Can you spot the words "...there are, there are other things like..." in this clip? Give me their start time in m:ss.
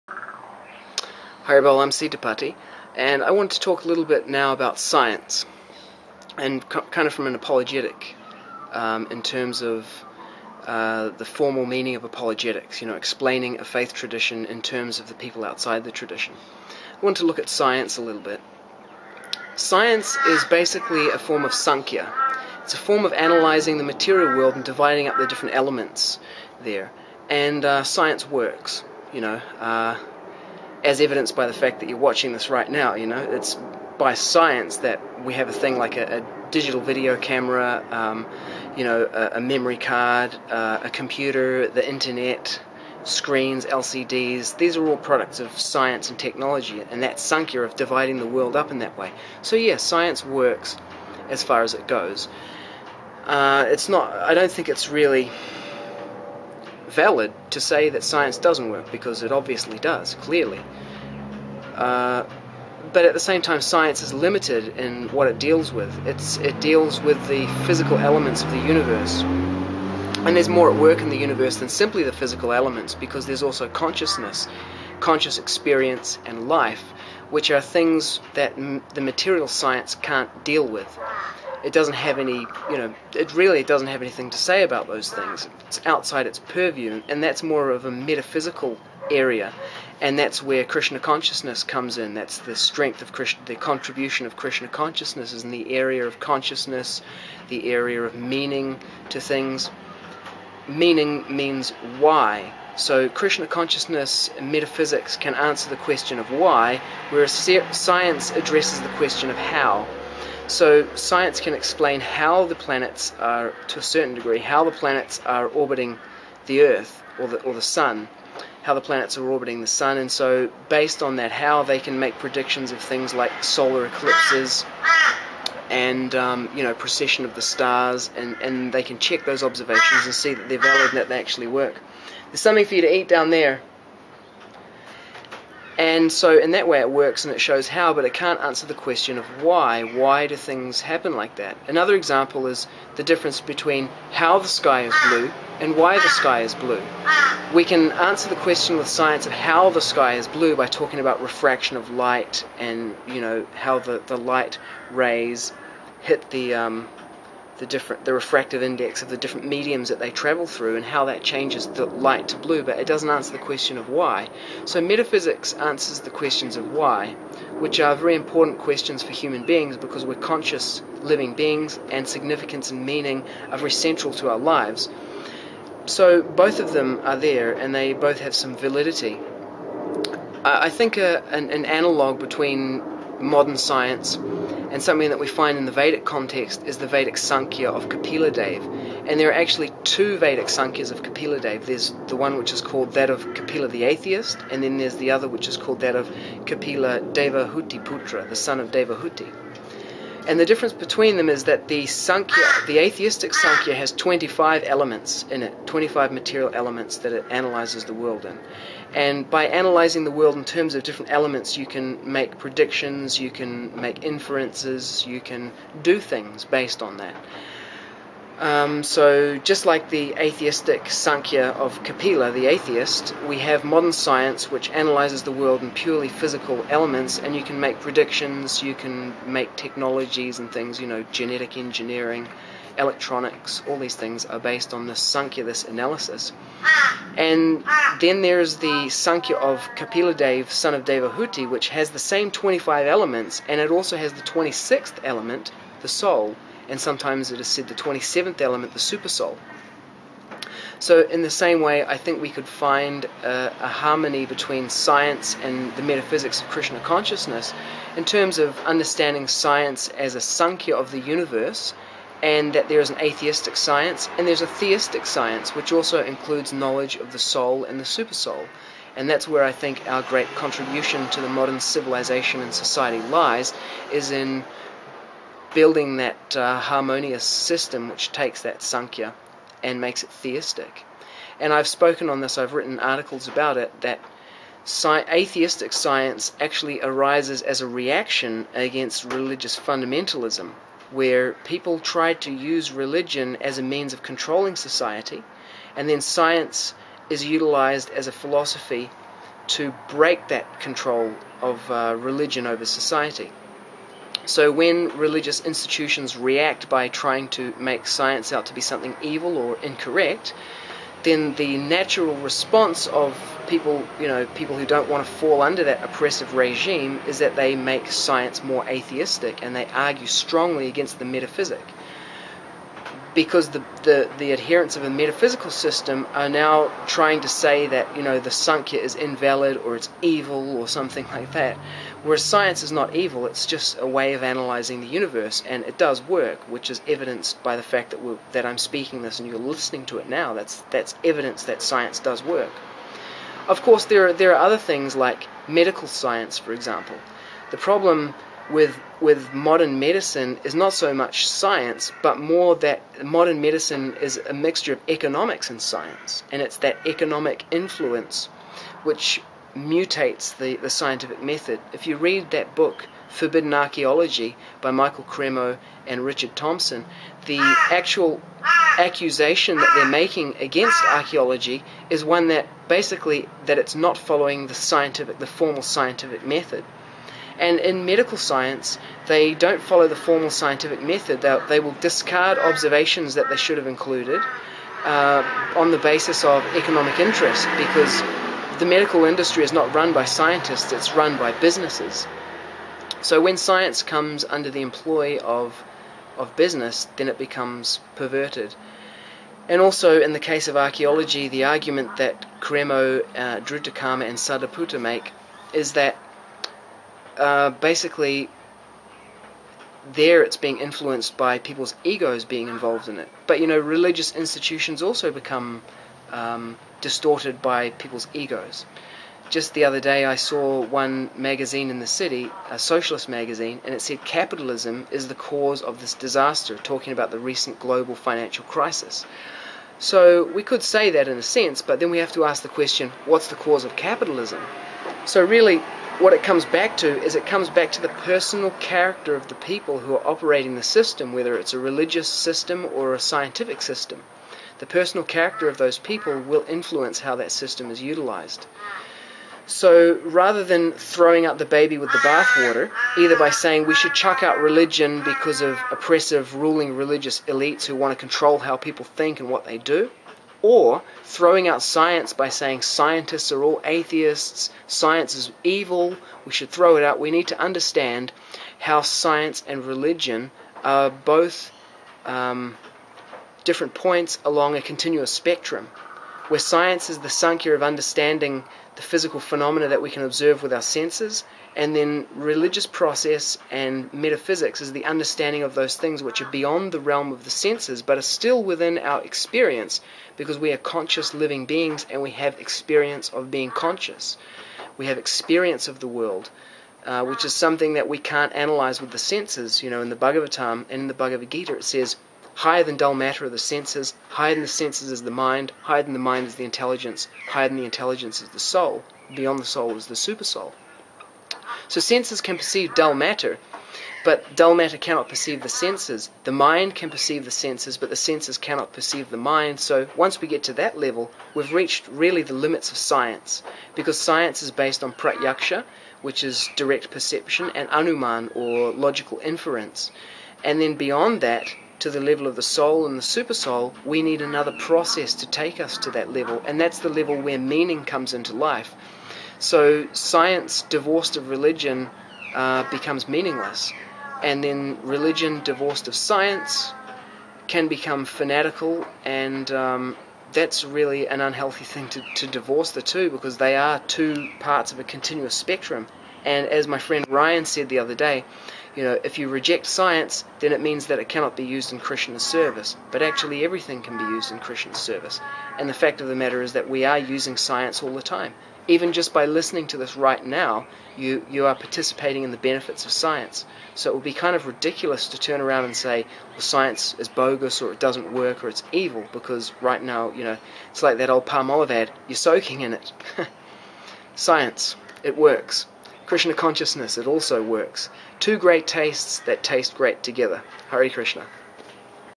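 5:43.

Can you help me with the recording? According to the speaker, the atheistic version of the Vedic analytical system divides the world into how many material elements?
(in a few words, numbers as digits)
25.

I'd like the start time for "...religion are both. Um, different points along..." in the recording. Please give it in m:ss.
7:49.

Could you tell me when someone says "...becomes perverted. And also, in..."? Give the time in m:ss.
6:37.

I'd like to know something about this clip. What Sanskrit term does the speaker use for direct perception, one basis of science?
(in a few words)
pratyaksha.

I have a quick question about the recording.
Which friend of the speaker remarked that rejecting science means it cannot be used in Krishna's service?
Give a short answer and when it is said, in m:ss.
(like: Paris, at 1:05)
Ryan, at 9:17.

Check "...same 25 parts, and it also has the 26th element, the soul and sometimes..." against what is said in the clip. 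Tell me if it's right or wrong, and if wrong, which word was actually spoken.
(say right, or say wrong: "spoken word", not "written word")
wrong: "elements", not "parts".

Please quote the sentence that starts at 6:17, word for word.
And in medical science, they don't follow the formal scientific method.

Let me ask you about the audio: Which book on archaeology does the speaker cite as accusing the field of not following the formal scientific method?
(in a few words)
Forbidden Archaeology.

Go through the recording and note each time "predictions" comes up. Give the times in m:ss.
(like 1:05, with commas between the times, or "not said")
2:02, 3:32, 3:47.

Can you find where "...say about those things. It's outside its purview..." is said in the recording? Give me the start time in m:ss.
1:24.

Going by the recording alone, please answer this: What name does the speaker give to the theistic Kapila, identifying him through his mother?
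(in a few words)
Kapila Huti Putra.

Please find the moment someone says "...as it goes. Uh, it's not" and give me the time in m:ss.
0:51.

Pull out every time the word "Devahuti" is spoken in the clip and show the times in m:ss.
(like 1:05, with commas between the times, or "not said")
3:18, 4:00.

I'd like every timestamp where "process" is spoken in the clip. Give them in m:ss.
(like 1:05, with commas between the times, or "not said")
8:02, 8:54.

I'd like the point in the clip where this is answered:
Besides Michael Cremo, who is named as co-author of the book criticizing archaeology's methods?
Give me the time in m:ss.
6:06.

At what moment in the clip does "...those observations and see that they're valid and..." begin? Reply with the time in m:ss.
2:09.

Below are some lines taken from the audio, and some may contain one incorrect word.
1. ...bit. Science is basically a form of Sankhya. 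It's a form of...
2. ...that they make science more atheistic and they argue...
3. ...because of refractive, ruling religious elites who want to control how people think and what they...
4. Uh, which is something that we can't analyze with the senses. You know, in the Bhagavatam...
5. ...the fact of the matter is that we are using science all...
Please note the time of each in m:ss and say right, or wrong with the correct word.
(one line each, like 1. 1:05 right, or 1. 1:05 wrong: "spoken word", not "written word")
1. 0:18 right
2. 5:17 right
3. 7:35 wrong: "oppressive", not "refractive"
4. 8:16 right
5. 9:25 right.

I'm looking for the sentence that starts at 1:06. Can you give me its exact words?
It's, it deals with the physical elements of the universe.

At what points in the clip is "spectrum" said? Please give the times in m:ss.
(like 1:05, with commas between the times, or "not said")
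7:55, 9:15.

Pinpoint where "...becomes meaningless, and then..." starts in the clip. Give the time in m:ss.
9:02.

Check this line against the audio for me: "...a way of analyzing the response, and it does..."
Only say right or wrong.
wrong.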